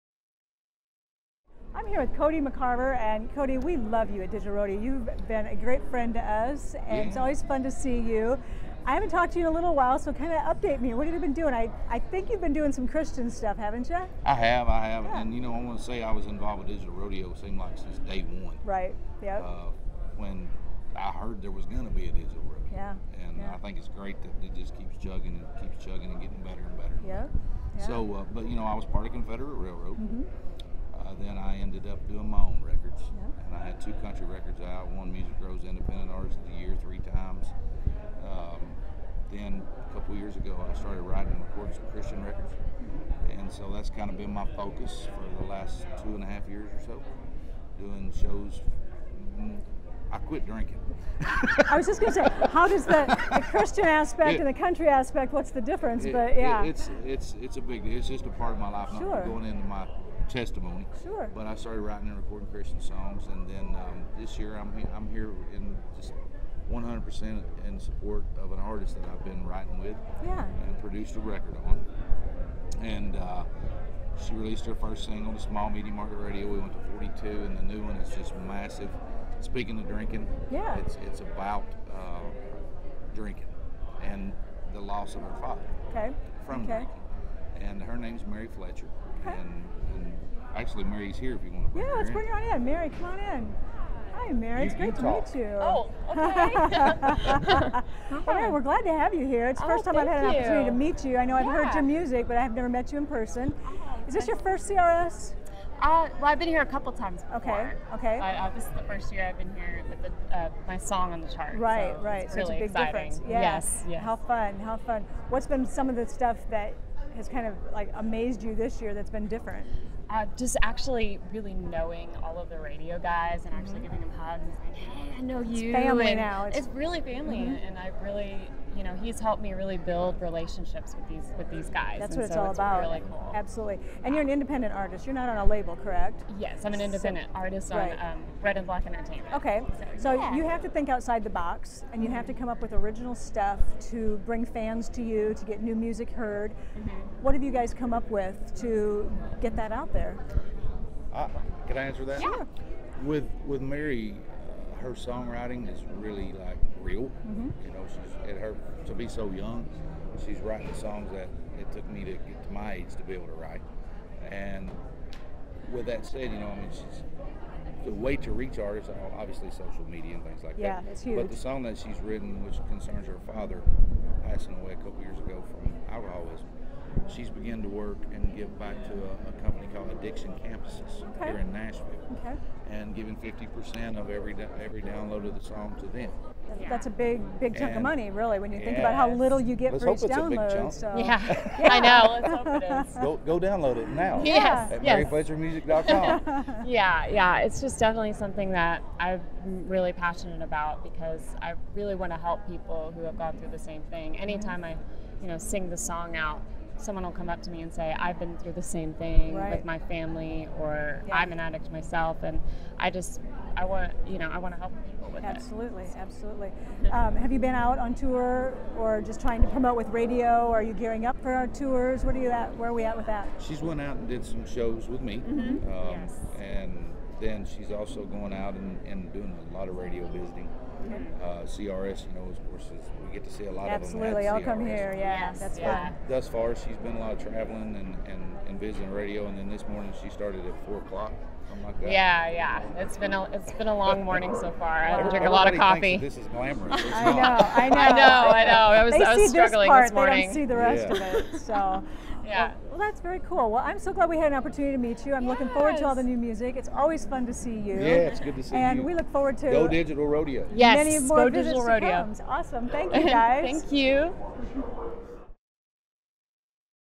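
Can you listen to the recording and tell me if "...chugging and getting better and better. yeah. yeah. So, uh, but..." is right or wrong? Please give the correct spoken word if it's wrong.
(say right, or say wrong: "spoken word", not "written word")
right.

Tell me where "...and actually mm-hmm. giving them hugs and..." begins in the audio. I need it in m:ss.
2:03.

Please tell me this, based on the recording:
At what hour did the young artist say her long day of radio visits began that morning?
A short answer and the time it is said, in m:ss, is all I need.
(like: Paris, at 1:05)
4 o'clock, at 4:00.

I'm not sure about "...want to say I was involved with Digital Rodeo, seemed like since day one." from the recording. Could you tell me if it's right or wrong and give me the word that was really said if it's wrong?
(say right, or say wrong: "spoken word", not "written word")
right.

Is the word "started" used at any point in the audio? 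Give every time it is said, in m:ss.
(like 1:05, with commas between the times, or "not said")
0:40, 1:01, 4:00.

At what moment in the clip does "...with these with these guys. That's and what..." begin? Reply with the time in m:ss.
2:10.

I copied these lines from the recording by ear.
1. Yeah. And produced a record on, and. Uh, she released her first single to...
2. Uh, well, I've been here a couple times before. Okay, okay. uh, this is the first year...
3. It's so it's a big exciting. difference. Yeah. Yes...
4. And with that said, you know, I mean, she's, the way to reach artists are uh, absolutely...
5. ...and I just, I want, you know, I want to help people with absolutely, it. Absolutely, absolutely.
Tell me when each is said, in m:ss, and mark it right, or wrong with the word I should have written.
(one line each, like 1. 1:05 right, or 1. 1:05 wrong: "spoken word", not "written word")
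1. 1:10 right
2. 1:45 right
3. 1:52 right
4. 2:44 wrong: "obviously", not "absolutely"
5. 3:32 right.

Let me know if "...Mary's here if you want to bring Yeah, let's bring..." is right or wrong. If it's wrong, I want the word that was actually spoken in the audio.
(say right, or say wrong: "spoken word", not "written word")
right.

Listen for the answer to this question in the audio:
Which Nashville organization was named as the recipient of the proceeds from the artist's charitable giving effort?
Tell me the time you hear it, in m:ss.
2:59.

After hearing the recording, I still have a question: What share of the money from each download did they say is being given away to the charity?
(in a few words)
50%.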